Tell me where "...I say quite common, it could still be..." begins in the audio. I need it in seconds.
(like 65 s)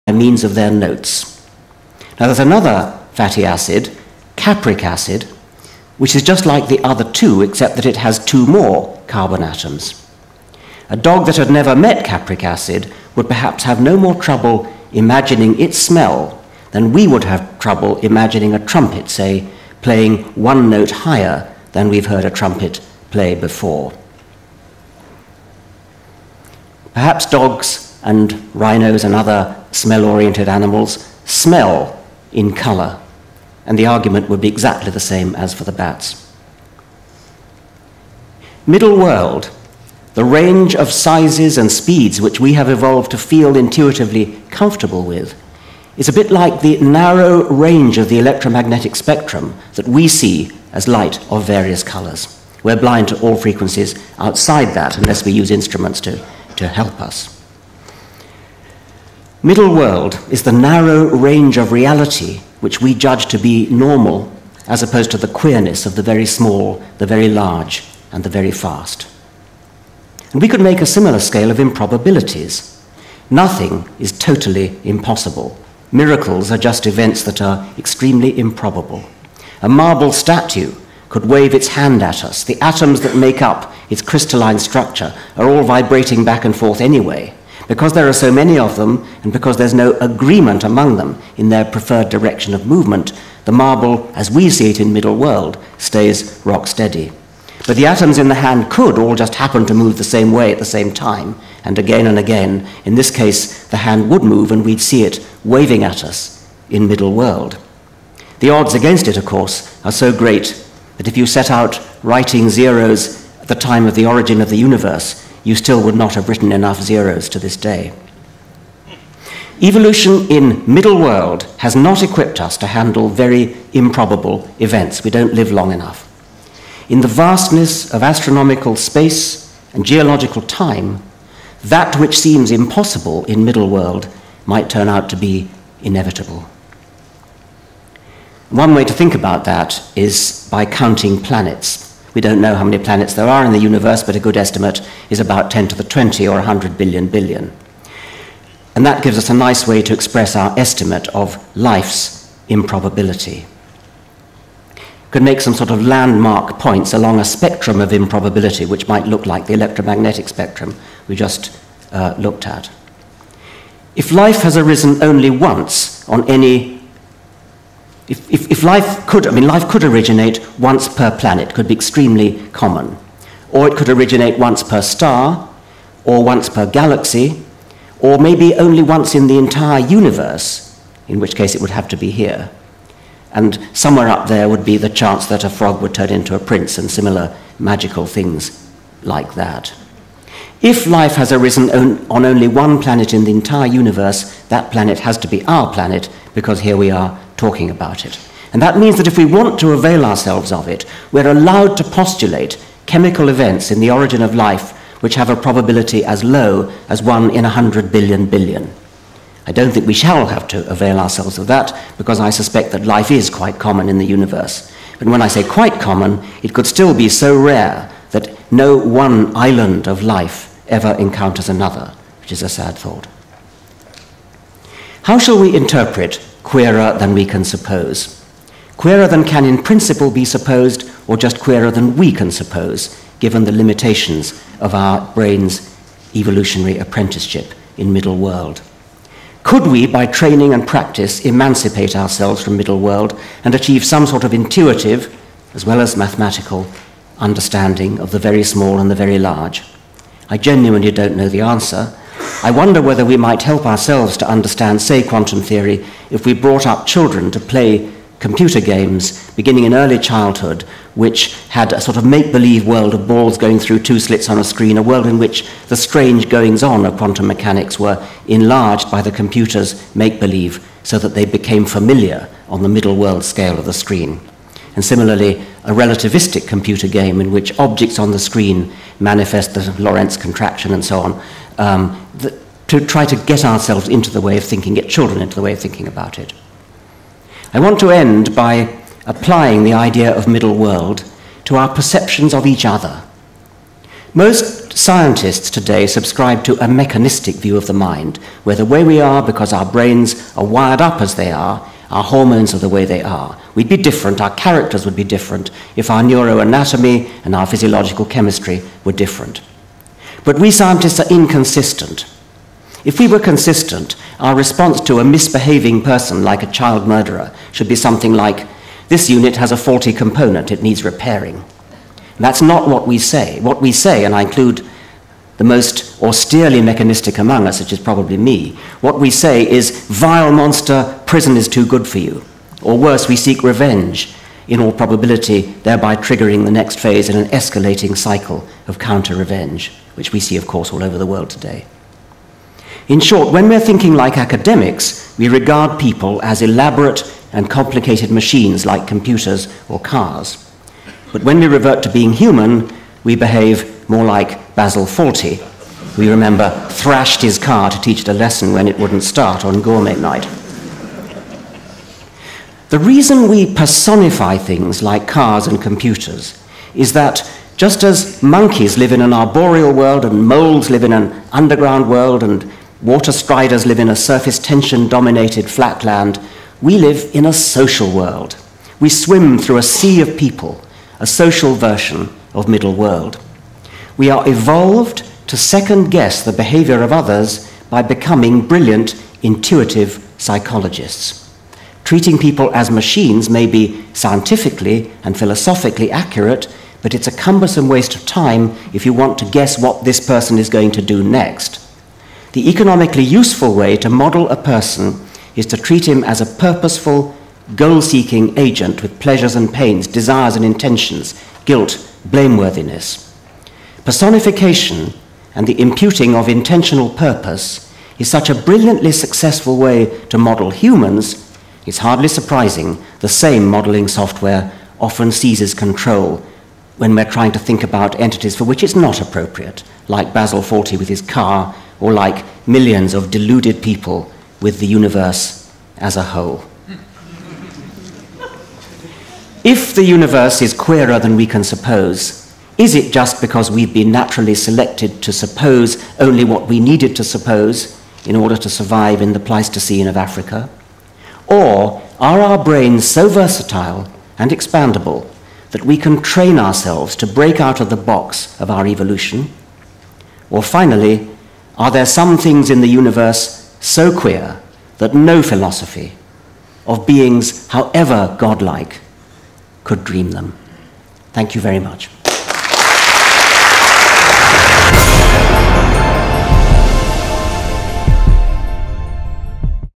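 215 s.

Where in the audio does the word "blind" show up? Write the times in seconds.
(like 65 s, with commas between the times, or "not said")
52 s.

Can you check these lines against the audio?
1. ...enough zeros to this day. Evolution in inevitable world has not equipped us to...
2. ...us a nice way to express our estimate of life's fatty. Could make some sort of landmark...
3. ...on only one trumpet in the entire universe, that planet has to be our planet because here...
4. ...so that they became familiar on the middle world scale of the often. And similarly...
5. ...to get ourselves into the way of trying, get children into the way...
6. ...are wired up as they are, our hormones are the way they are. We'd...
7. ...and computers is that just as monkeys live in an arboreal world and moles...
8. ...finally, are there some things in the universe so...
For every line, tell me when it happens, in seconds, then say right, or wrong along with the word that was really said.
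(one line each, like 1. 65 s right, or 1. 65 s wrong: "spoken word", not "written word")
1. 116 s wrong: "middle", not "inevitable"
2. 149 s wrong: "improbability", not "fatty"
3. 192 s wrong: "planet", not "trumpet"
4. 270 s wrong: "screen", not "often"
5. 283 s wrong: "thinking", not "trying"
6. 300 s right
7. 365 s right
8. 460 s right.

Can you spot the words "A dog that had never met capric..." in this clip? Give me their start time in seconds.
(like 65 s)
10 s.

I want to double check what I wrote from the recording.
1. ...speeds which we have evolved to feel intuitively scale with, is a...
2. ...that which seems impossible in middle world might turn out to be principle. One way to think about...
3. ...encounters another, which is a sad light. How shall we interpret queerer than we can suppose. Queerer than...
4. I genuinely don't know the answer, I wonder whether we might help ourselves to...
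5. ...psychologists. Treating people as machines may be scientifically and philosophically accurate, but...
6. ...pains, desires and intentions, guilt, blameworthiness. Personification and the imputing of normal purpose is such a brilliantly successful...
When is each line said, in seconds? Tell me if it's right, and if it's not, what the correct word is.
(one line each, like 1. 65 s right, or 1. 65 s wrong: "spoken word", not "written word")
1. 41 s wrong: "comfortable", not "scale"
2. 131 s wrong: "inevitable", not "principle"
3. 220 s wrong: "thought", not "light"
4. 250 s right
5. 390 s right
6. 409 s wrong: "intentional", not "normal".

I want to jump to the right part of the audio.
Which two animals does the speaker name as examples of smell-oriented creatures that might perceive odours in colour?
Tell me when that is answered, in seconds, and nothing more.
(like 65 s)
27 s.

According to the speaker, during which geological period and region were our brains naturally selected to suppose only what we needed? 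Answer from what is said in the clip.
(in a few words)
Pleistocene of Africa.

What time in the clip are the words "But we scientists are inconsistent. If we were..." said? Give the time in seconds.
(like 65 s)
310 s.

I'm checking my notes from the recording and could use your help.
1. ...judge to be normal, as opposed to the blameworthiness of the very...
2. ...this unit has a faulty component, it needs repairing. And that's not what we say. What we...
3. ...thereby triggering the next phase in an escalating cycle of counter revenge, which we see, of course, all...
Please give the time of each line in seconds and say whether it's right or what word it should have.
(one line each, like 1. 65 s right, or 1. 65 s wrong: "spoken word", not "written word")
1. 62 s wrong: "queerness", not "blameworthiness"
2. 318 s right
3. 335 s right.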